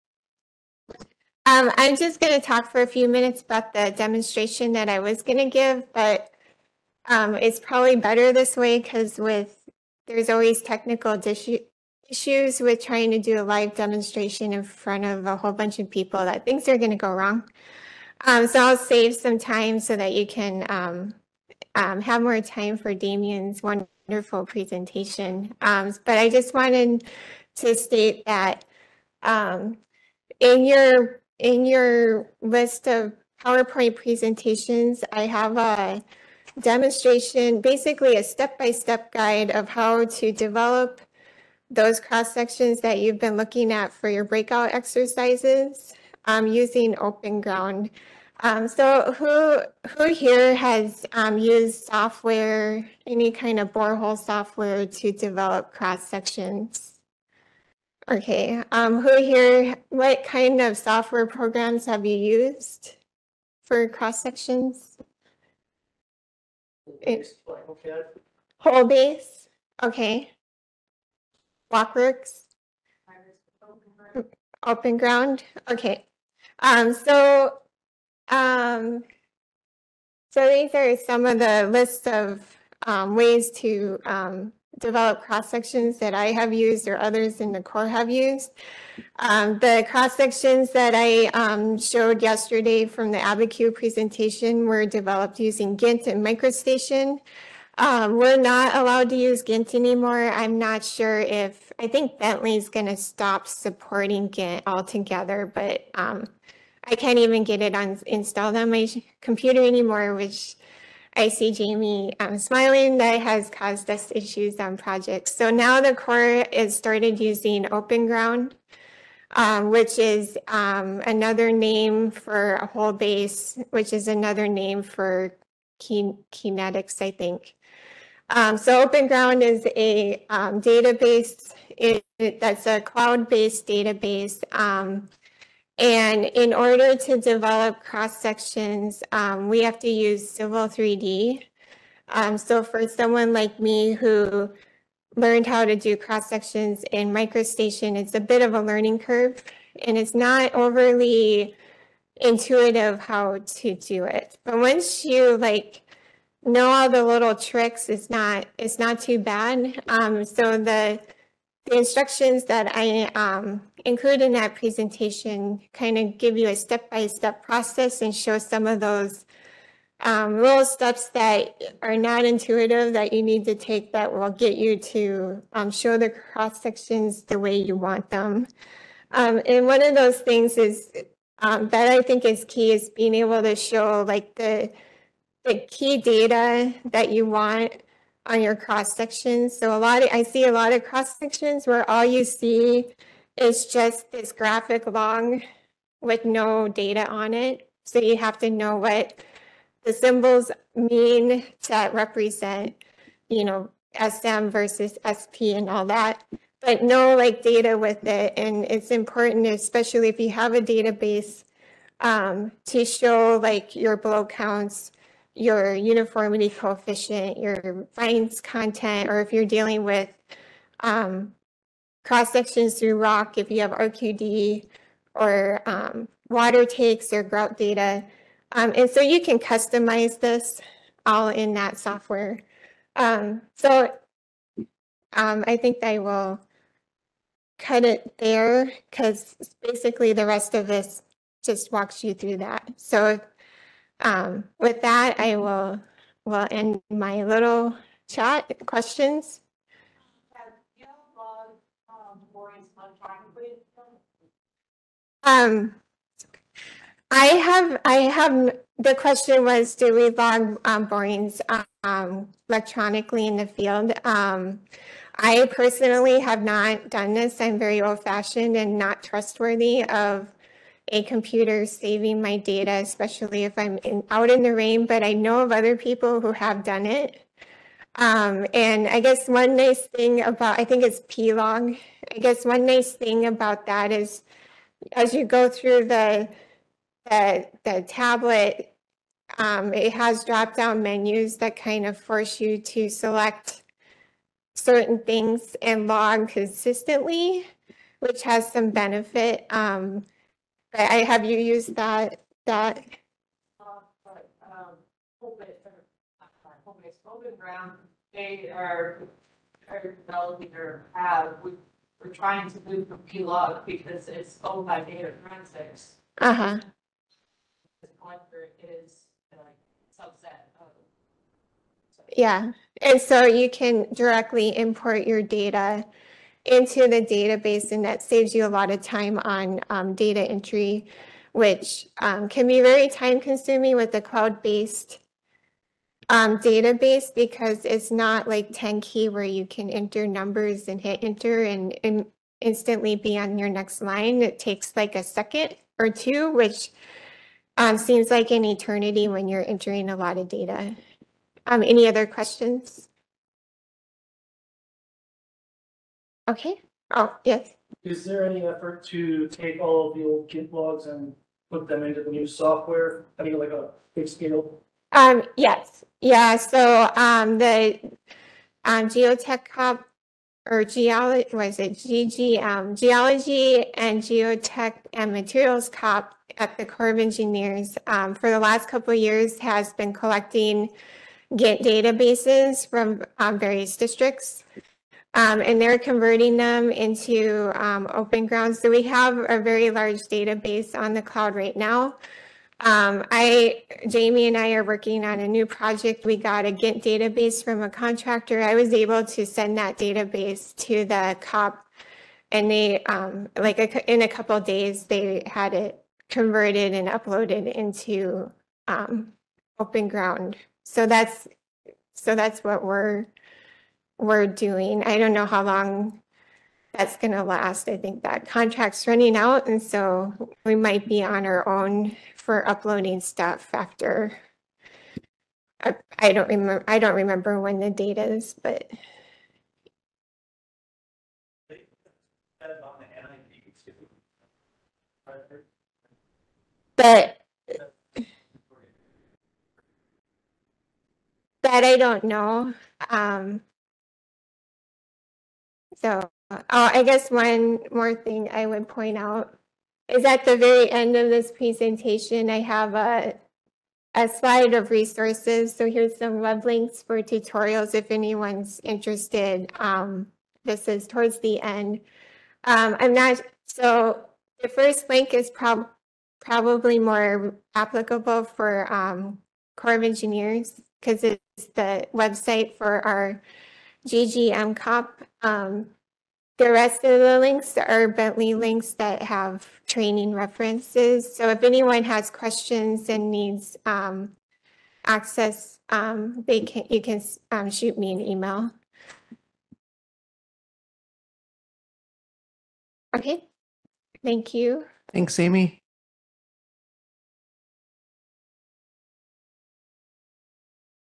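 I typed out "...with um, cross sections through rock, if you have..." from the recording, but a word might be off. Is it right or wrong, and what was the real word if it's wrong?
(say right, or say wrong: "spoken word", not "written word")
right.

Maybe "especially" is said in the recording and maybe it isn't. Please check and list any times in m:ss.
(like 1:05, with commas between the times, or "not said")
3:29, 4:32.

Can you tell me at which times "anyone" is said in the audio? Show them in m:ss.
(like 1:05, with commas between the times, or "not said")
7:37, 8:01.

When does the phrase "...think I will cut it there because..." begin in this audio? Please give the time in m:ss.
3:55.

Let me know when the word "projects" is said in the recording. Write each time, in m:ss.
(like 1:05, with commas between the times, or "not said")
1:54, 6:35.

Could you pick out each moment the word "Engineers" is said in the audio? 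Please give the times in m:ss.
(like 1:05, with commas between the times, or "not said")
6:16, 7:49.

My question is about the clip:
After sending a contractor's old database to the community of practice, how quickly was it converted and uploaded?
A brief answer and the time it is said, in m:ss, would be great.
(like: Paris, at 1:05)
a couple days, at 6:44.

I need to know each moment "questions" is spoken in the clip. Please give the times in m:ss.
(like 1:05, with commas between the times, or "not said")
4:08, 4:18, 5:52, 8:02.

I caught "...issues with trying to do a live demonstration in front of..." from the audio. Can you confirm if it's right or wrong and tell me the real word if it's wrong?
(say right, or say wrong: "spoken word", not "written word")
right.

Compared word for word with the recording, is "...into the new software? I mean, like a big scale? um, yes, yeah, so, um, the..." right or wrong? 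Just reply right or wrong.
right.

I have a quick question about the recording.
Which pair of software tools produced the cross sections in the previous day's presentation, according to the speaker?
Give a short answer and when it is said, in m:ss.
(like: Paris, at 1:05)
gINT and MicroStation, at 1:35.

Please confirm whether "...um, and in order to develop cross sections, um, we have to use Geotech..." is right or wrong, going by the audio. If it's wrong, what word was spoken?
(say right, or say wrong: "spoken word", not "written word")
wrong: "Civil", not "Geotech".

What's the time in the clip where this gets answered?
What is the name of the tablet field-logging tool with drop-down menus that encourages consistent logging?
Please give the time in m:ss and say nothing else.
4:41.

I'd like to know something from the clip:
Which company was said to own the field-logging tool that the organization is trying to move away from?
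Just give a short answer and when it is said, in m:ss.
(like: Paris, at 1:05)
Data Forensics, at 5:14.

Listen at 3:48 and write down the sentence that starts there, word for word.
Um, and so you can customize this all in that software.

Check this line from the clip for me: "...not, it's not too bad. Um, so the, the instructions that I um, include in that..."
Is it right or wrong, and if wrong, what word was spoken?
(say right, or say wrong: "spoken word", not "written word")
right.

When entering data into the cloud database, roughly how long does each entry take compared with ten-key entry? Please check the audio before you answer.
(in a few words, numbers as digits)
a second or two.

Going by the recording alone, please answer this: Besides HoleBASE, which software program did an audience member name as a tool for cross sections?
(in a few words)
Blockworks.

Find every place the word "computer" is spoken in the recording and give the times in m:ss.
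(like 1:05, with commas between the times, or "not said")
1:49, 4:31.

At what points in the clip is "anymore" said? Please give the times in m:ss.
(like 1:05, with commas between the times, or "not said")
1:39, 1:49.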